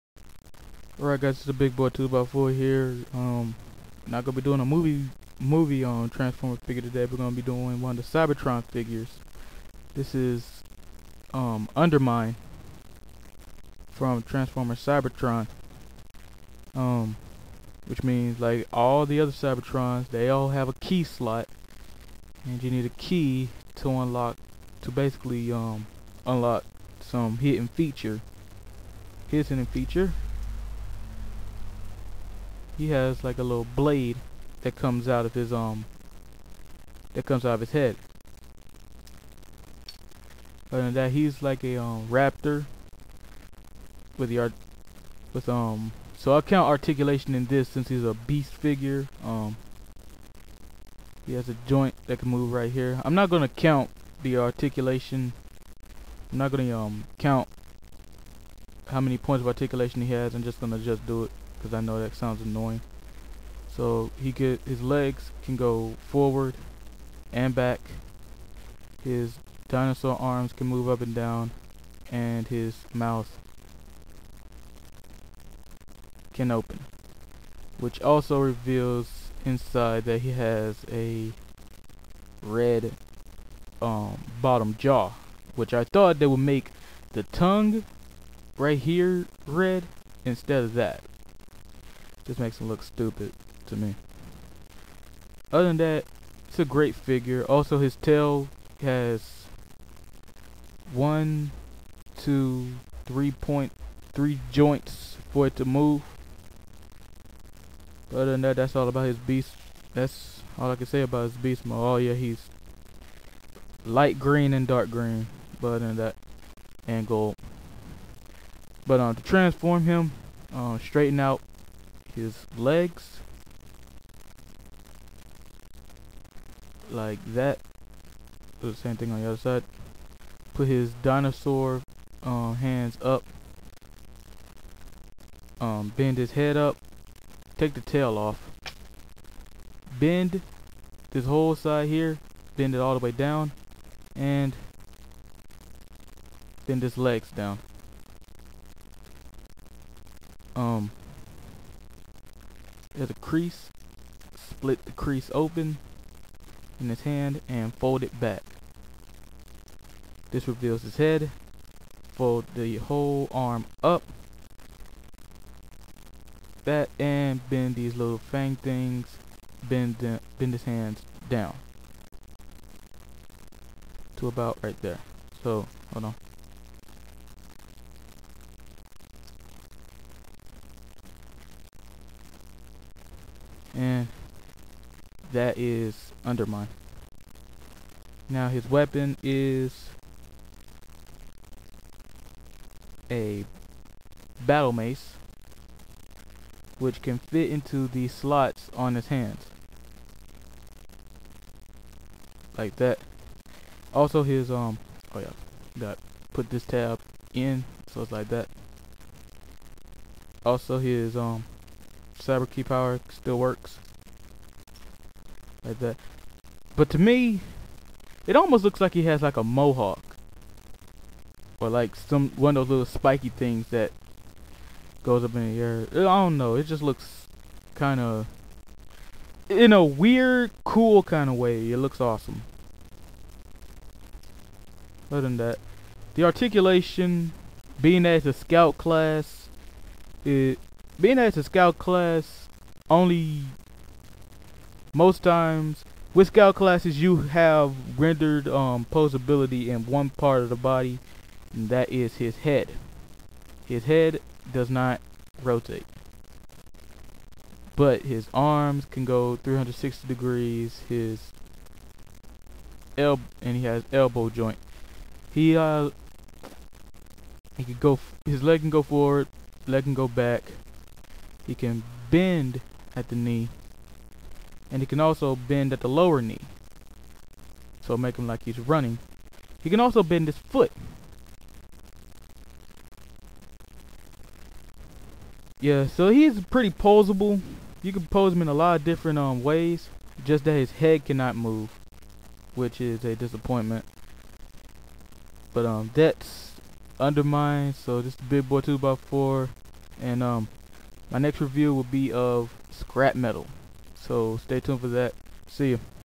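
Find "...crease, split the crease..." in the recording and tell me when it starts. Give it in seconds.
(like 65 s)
153 s.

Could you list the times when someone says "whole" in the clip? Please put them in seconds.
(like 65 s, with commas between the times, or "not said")
141 s, 162 s.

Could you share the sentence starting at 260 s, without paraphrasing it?
His elbow, and he has elbow joint.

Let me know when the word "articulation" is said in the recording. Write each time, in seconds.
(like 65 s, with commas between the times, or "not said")
46 s, 54 s, 59 s, 236 s.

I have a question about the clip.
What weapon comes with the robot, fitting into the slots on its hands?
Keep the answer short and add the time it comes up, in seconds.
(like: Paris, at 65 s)
battle mace, at 194 s.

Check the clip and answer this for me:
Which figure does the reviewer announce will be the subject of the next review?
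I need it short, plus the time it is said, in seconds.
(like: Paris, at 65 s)
Scrap Metal, at 302 s.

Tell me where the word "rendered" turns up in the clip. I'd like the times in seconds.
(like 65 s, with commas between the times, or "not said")
247 s.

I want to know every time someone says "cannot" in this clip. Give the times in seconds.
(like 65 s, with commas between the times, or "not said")
291 s.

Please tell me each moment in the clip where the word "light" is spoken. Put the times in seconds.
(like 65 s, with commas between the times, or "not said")
113 s.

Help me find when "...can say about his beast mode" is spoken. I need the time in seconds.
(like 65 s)
110 s.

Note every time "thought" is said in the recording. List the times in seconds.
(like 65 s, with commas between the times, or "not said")
85 s.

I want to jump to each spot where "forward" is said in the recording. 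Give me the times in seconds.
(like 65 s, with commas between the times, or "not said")
66 s, 268 s.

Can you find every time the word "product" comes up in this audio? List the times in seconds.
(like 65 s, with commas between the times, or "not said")
not said.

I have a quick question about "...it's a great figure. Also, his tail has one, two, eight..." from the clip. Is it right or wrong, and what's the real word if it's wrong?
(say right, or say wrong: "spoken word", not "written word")
wrong: "three", not "eight".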